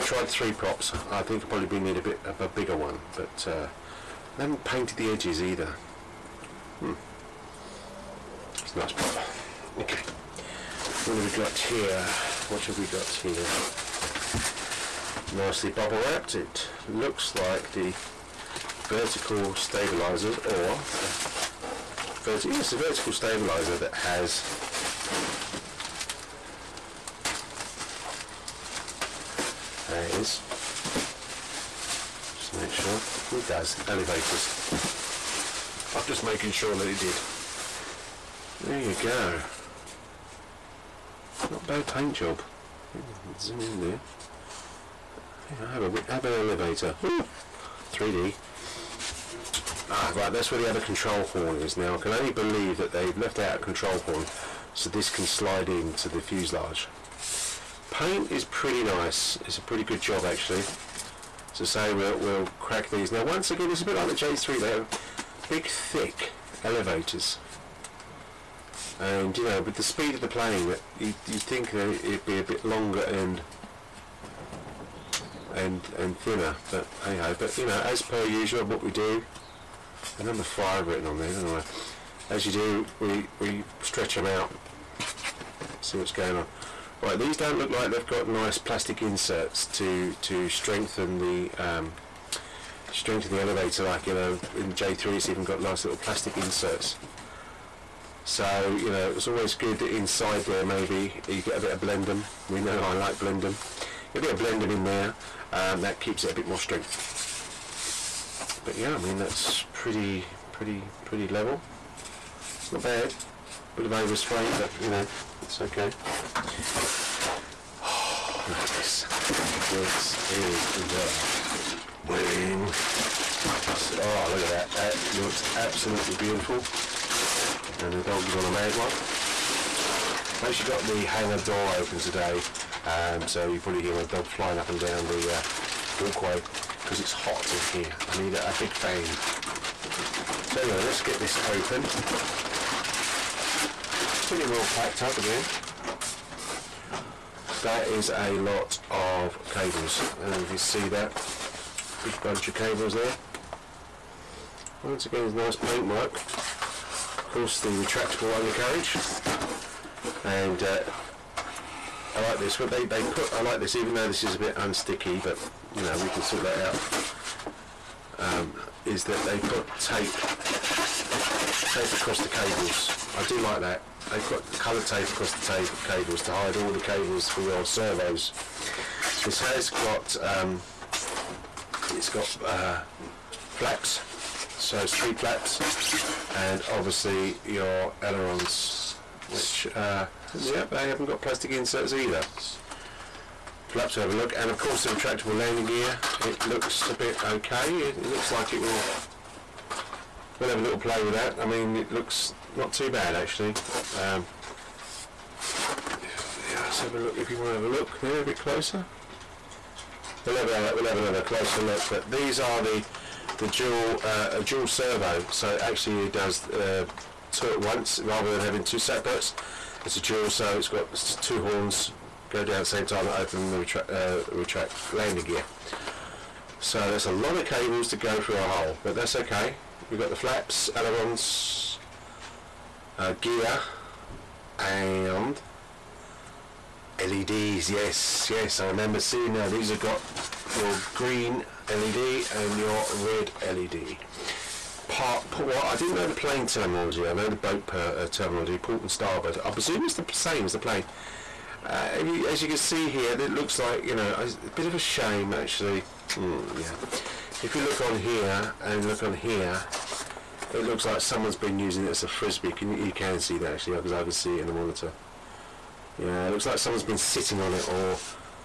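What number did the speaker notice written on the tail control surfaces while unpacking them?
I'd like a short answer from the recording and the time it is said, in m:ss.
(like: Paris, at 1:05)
5, at 1:20.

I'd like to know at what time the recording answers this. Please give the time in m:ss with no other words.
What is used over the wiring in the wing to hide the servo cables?
2:54.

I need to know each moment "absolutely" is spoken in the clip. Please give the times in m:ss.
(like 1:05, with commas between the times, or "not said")
2:05.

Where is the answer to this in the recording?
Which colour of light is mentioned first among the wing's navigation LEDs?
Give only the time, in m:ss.
4:00.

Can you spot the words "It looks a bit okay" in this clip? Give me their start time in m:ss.
3:16.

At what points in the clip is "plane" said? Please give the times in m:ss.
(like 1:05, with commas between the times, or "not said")
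1:10, 4:06, 4:10.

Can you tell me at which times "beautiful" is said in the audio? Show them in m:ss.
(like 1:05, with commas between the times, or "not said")
2:06.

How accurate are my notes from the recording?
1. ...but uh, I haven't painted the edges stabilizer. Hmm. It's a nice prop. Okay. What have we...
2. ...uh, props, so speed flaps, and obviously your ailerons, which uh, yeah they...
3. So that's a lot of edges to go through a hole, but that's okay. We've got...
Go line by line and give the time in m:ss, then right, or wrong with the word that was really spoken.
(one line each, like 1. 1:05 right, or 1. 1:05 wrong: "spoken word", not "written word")
1. 0:03 wrong: "either", not "stabilizer"
2. 3:02 wrong: "flaps", not "props"
3. 3:46 wrong: "cables", not "edges".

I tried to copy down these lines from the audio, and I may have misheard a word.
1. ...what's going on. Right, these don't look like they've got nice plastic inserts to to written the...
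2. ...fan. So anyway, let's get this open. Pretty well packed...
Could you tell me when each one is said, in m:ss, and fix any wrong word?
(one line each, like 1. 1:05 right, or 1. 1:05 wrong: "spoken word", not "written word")
1. 1:25 wrong: "strengthen", not "written"
2. 2:18 right.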